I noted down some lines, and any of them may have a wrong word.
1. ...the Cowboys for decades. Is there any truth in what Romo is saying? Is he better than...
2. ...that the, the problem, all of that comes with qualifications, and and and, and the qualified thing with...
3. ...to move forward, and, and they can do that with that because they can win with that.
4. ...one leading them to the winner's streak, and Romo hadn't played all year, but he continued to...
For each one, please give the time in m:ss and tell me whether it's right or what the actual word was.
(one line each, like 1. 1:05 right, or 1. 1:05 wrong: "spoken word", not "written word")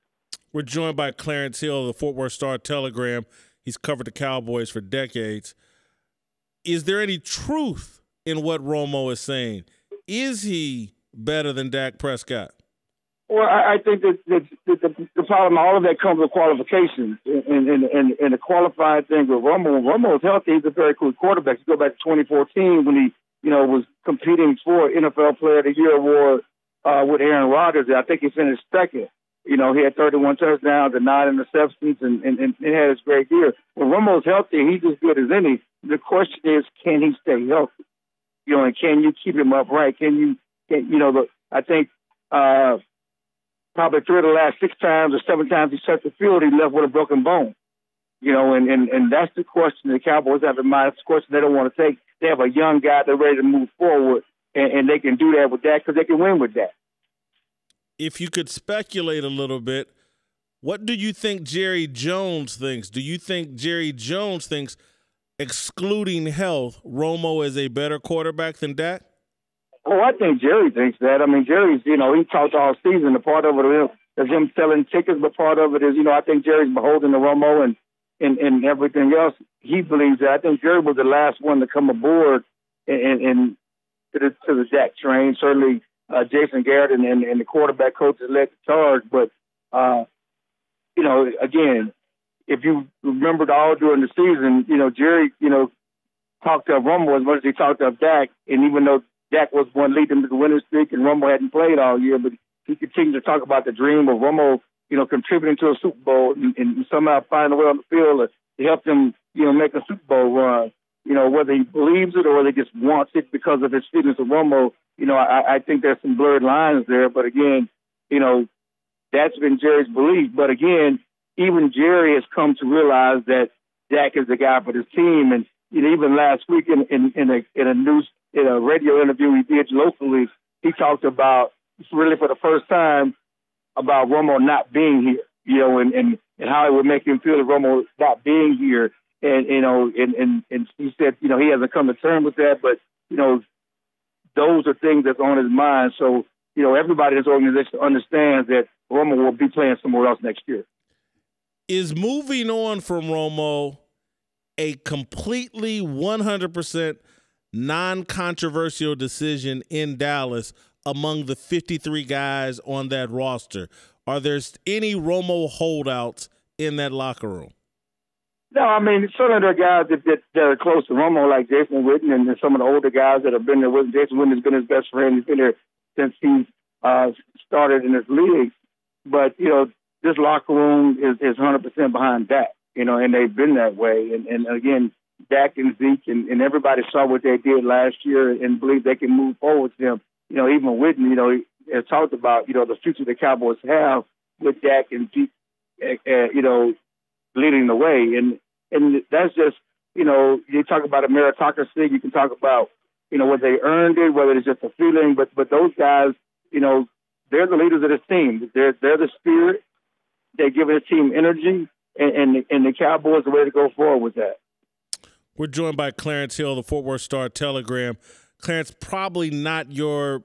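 1. 0:04 right
2. 0:14 right
3. 0:53 right
4. 1:39 right.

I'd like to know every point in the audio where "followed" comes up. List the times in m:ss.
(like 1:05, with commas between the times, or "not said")
not said.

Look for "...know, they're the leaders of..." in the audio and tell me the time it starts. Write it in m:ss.
3:26.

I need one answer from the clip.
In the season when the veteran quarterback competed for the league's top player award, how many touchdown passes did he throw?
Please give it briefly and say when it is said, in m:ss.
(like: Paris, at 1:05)
31, at 0:29.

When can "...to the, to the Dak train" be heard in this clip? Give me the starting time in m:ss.
1:24.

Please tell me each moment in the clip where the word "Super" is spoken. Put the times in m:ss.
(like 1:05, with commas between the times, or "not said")
1:45, 1:49.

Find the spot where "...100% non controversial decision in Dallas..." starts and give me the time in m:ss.
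2:35.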